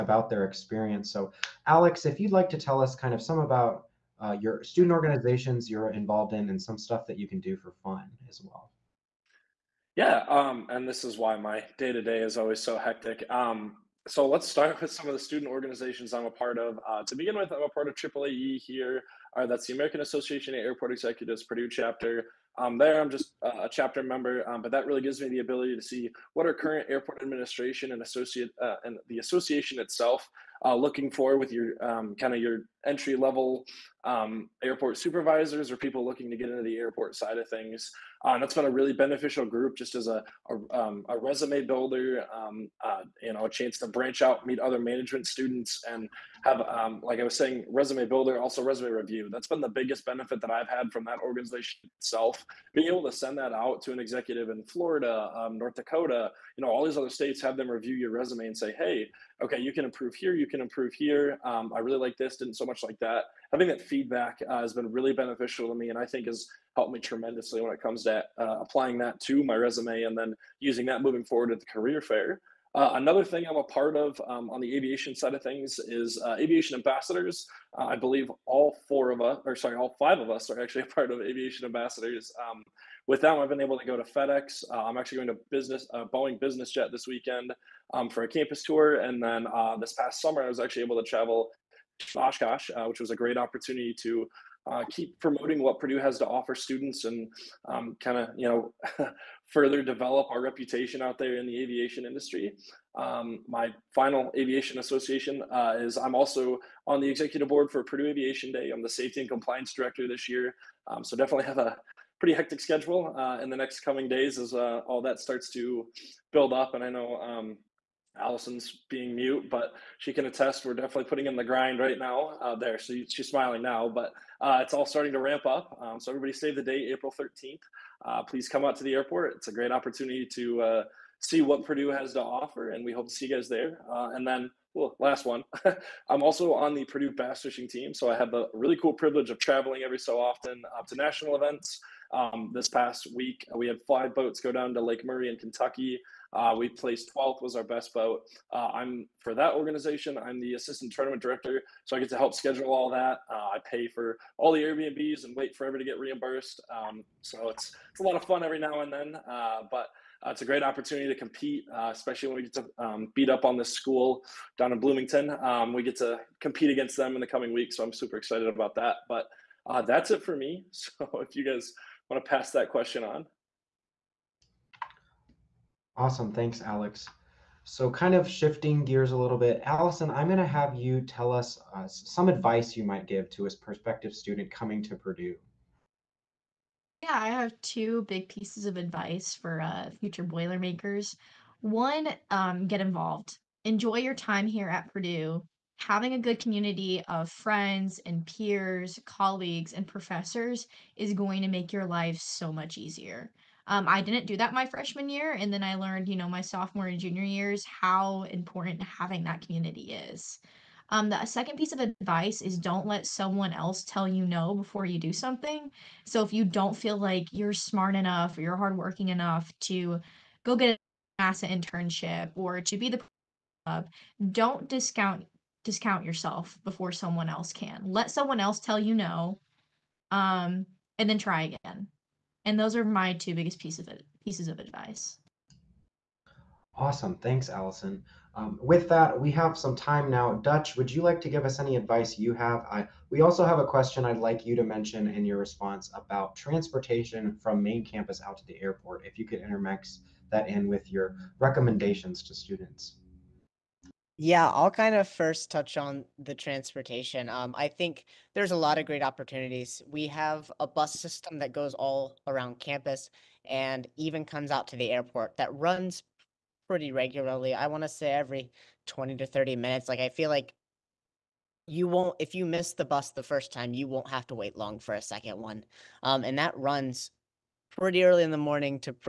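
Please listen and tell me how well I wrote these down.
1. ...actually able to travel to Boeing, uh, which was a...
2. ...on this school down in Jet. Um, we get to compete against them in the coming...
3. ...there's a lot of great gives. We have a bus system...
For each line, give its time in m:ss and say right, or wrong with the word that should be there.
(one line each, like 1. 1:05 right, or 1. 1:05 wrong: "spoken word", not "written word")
1. 1:30 wrong: "Oshkosh", not "Boeing"
2. 2:43 wrong: "Bloomington", not "Jet"
3. 4:18 wrong: "opportunities", not "gives".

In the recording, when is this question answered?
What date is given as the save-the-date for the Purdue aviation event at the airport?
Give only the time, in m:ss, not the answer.
2:06.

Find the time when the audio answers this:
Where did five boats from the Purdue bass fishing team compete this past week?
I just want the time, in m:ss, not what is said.
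2:24.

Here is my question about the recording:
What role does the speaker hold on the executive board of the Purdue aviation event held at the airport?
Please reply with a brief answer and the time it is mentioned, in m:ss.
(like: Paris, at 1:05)
Safety and compliance director, at 1:48.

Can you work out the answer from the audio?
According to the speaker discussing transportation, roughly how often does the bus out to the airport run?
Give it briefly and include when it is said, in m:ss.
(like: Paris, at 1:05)
Every 20 to 30 minutes, at 4:28.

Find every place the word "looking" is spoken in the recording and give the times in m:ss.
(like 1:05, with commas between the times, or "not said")
0:30, 0:36.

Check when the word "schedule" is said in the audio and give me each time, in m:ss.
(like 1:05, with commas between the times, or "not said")
1:52, 2:32.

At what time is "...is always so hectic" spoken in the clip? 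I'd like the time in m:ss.
0:12.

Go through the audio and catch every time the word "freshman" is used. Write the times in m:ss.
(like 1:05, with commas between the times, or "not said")
3:24.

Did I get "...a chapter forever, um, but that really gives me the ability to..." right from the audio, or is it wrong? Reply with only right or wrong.
wrong.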